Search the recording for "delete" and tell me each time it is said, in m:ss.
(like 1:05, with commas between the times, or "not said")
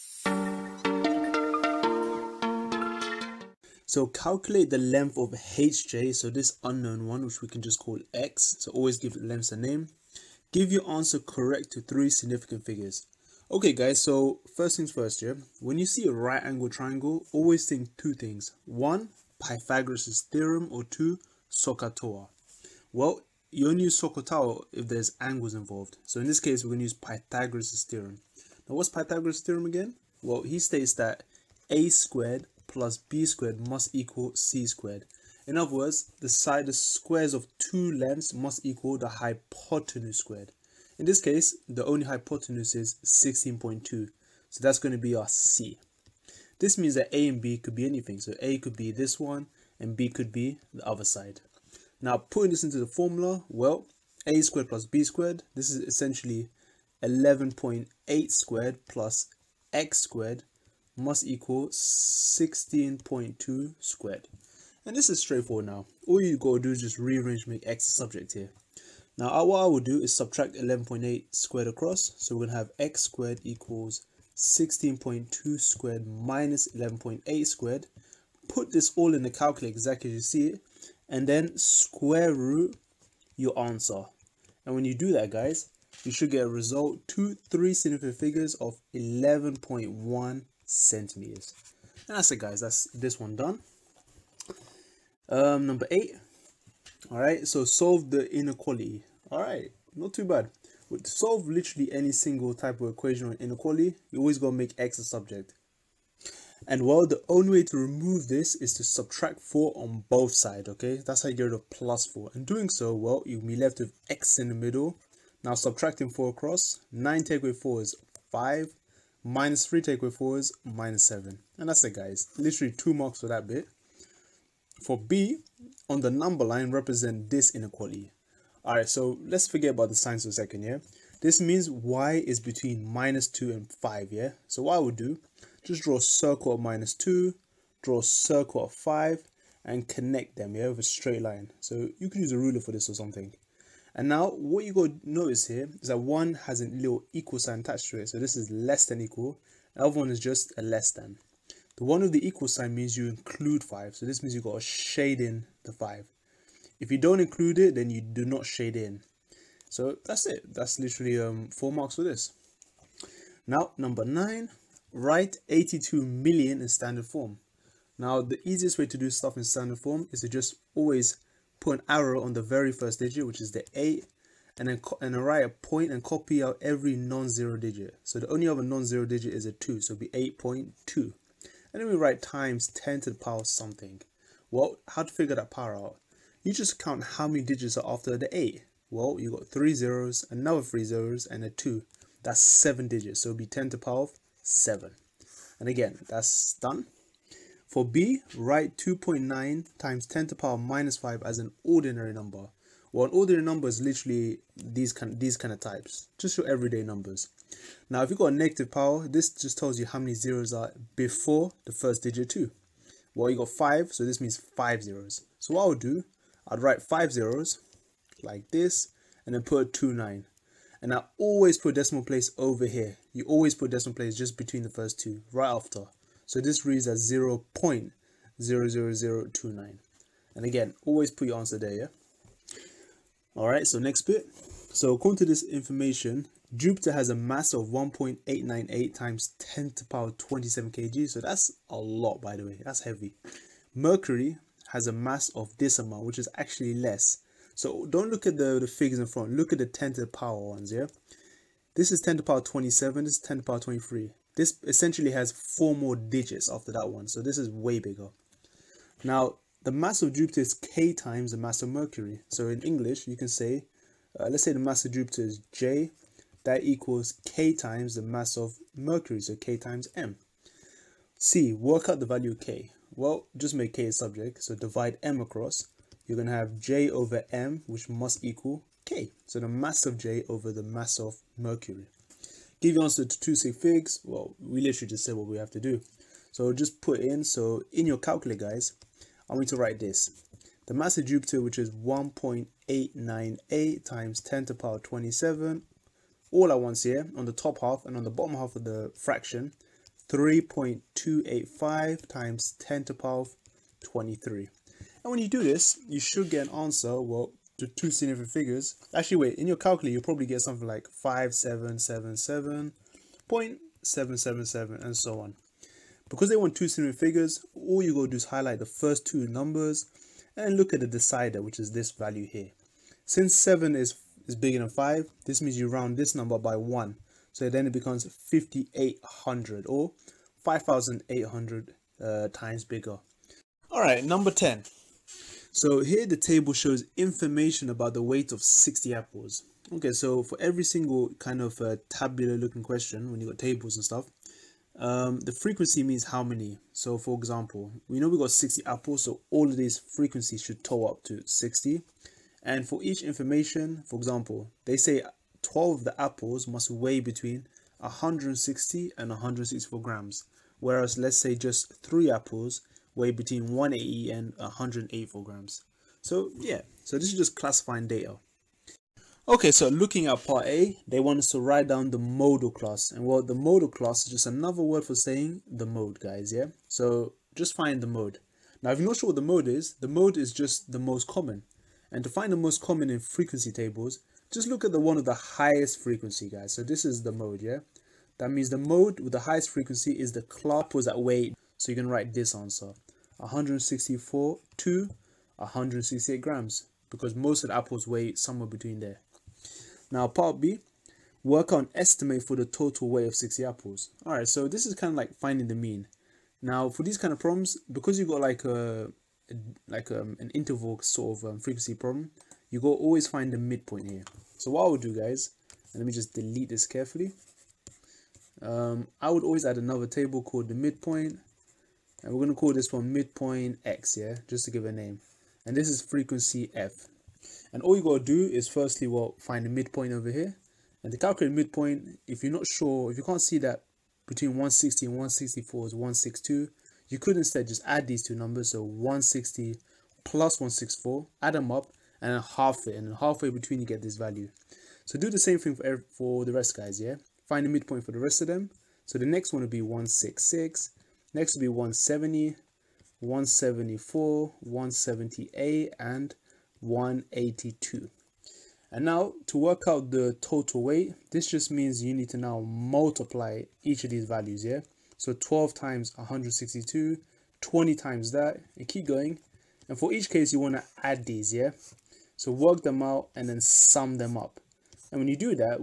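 6:56.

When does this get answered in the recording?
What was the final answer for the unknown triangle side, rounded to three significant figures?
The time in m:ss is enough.
1:28.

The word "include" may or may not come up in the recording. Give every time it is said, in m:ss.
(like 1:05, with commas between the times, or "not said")
2:33, 2:37.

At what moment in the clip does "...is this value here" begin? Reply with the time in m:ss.
5:21.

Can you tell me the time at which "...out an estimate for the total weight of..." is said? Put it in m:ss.
6:41.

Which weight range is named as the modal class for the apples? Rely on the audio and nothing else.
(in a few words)
164 to 168 grams.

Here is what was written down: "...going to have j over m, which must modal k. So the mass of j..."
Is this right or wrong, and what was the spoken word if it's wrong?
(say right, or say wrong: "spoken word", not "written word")
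wrong: "equal", not "modal".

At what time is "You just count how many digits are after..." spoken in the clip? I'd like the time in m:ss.
3:06.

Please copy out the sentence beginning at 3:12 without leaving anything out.
That's 7 digits, so it'll be 10 to the power of 7.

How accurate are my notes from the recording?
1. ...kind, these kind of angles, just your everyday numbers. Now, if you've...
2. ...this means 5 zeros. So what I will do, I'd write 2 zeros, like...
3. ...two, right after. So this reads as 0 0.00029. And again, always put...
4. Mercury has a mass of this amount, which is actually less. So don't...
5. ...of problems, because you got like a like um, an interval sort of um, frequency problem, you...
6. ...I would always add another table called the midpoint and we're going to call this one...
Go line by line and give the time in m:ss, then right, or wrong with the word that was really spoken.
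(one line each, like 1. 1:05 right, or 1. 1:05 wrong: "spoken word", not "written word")
1. 3:24 wrong: "types", not "angles"
2. 3:34 wrong: "5", not "2"
3. 3:44 right
4. 4:03 right
5. 6:47 right
6. 6:58 right.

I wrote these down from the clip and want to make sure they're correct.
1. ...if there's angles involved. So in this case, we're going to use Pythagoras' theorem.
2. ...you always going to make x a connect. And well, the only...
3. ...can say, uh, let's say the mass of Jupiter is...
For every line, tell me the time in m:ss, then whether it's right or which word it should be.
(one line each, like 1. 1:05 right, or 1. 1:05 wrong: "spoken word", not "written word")
1. 0:24 right
2. 1:44 wrong: "subject", not "connect"
3. 4:23 right.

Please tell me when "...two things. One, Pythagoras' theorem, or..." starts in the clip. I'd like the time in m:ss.
0:17.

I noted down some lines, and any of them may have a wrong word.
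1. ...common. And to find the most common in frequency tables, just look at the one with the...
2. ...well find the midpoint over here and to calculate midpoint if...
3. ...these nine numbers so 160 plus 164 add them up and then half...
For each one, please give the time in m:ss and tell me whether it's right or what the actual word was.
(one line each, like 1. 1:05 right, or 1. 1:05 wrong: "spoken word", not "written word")
1. 6:21 right
2. 7:08 right
3. 7:17 wrong: "two", not "nine".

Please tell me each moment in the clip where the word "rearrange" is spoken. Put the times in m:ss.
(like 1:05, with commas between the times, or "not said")
1:06.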